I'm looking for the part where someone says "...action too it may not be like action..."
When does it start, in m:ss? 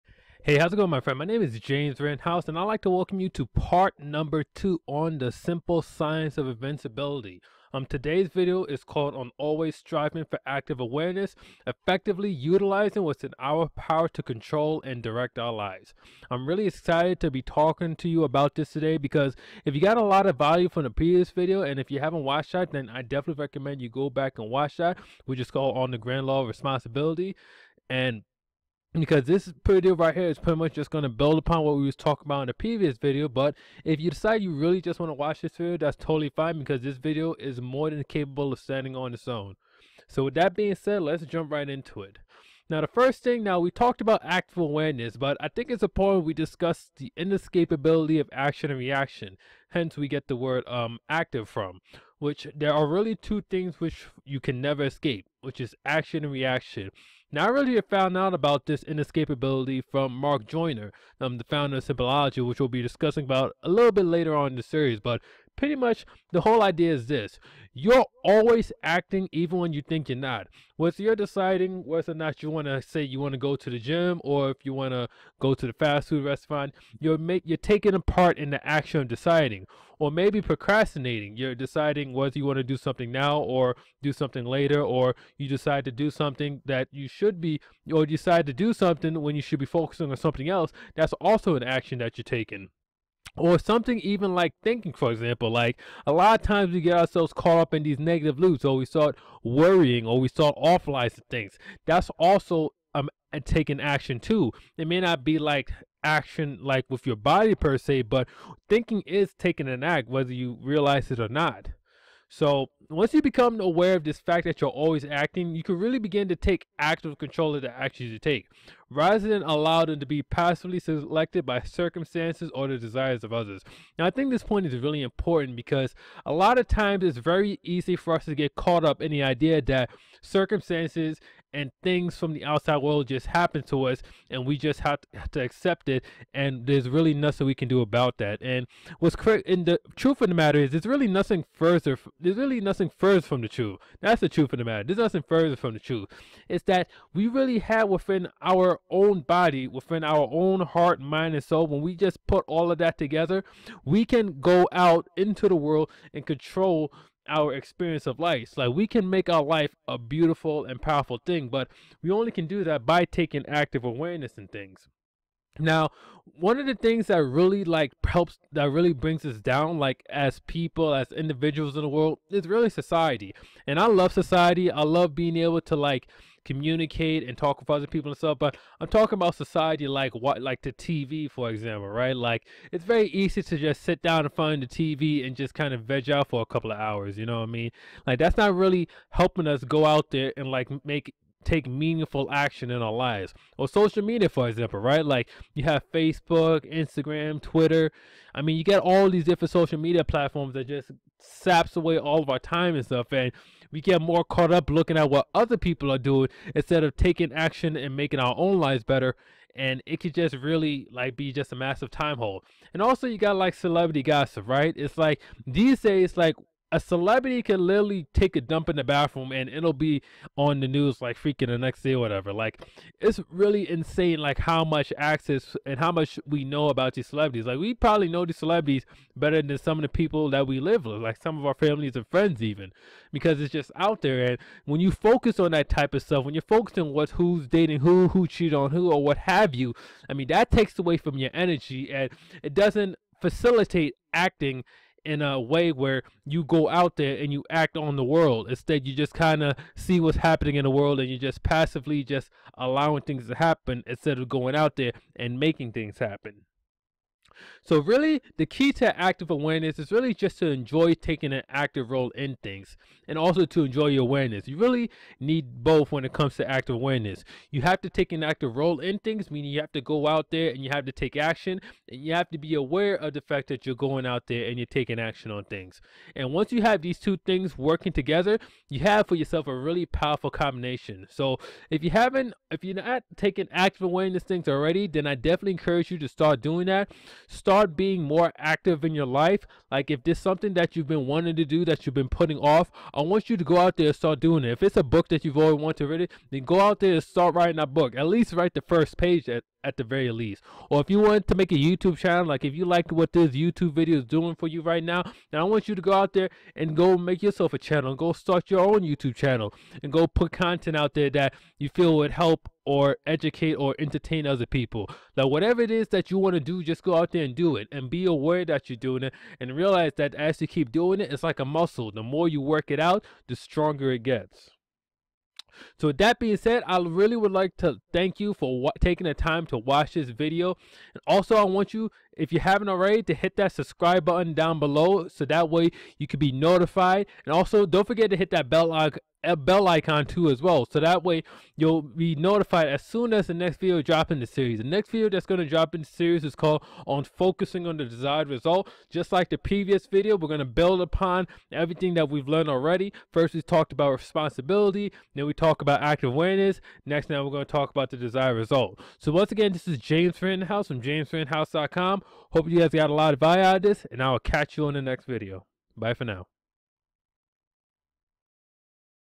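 1:43.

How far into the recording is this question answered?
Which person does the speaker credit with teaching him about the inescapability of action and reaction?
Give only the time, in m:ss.
1:00.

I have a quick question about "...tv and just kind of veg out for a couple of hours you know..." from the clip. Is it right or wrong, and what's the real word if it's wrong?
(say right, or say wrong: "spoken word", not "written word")
right.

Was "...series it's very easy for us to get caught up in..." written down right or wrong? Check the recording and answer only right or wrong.
wrong.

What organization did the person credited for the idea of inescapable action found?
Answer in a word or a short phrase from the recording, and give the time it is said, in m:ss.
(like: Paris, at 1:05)
Simpleology, at 1:01.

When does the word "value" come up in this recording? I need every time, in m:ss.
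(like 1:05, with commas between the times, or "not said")
0:20, 6:03.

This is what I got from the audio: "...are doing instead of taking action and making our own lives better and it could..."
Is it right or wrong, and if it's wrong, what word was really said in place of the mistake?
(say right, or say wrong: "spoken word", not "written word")
right.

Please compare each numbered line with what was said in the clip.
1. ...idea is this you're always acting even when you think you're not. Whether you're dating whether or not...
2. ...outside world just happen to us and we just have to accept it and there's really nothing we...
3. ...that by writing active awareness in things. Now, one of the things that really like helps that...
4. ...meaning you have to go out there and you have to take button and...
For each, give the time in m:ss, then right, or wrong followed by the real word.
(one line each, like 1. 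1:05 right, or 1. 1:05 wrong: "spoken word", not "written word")
1. 1:06 wrong: "deciding", not "dating"
2. 2:12 right
3. 2:42 wrong: "taking", not "writing"
4. 4:29 wrong: "action", not "button".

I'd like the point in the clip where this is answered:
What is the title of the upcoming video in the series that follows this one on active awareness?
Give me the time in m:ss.
5:46.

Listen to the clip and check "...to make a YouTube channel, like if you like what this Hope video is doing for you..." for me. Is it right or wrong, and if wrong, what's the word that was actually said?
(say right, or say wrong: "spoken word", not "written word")
wrong: "YouTube", not "Hope".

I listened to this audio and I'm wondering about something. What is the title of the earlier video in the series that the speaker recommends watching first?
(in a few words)
On the Grand Law of Responsibility.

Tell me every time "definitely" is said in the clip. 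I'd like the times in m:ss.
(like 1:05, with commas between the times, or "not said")
0:23, 4:45.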